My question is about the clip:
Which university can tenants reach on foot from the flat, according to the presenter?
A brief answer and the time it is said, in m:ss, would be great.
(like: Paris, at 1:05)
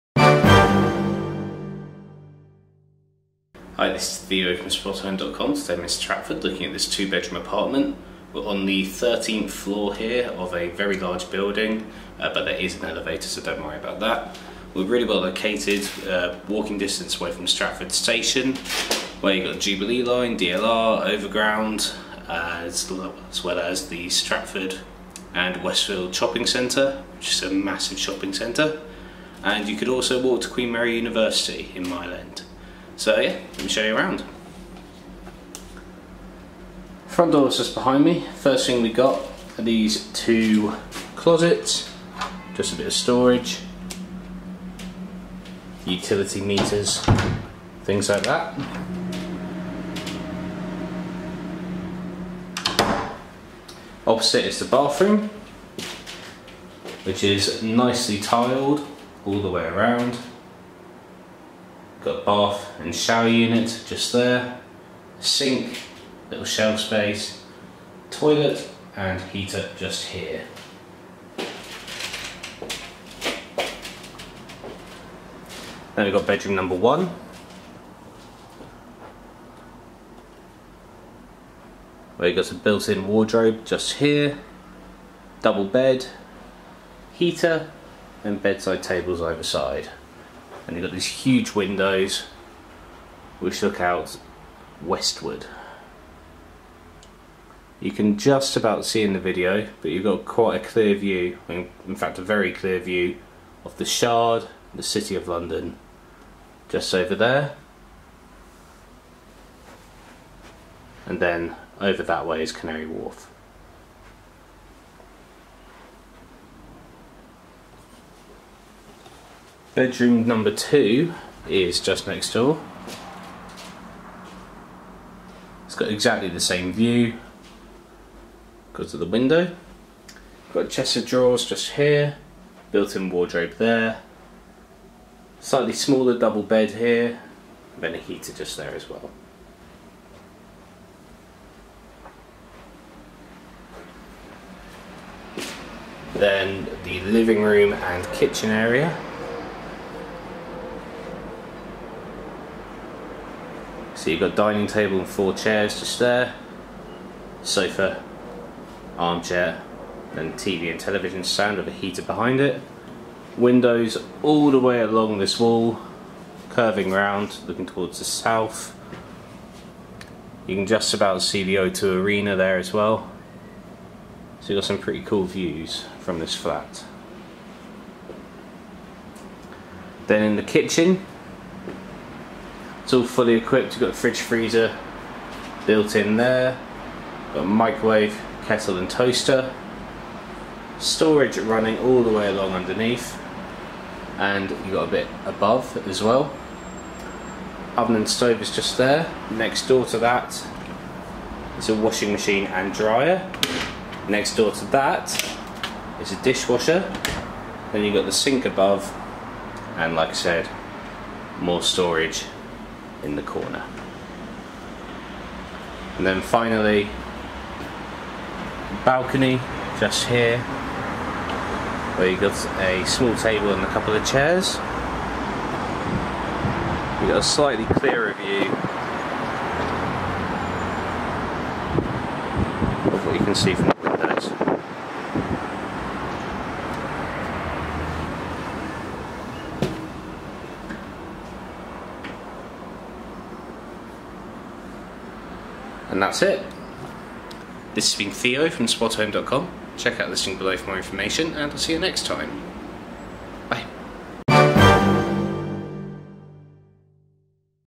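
Queen Mary University, at 0:30.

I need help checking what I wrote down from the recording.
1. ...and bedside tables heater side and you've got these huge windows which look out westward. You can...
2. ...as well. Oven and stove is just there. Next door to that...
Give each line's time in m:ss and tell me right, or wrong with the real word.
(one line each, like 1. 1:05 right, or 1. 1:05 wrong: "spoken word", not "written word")
1. 1:28 wrong: "either", not "heater"
2. 3:15 right.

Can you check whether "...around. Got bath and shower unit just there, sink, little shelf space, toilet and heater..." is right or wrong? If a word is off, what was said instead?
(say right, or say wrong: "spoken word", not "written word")
right.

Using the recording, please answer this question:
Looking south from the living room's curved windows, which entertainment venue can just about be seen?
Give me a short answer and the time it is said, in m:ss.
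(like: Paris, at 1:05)
O2 Arena, at 2:51.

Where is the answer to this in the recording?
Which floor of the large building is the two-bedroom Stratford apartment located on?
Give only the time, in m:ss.
0:08.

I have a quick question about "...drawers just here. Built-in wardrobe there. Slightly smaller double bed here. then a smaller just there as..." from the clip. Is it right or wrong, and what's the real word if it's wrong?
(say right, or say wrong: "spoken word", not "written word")
wrong: "heater", not "smaller".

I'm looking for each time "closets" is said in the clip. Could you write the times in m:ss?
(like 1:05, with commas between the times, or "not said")
0:41.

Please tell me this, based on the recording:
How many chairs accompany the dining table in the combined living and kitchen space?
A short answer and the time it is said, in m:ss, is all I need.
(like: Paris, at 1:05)
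4, at 2:35.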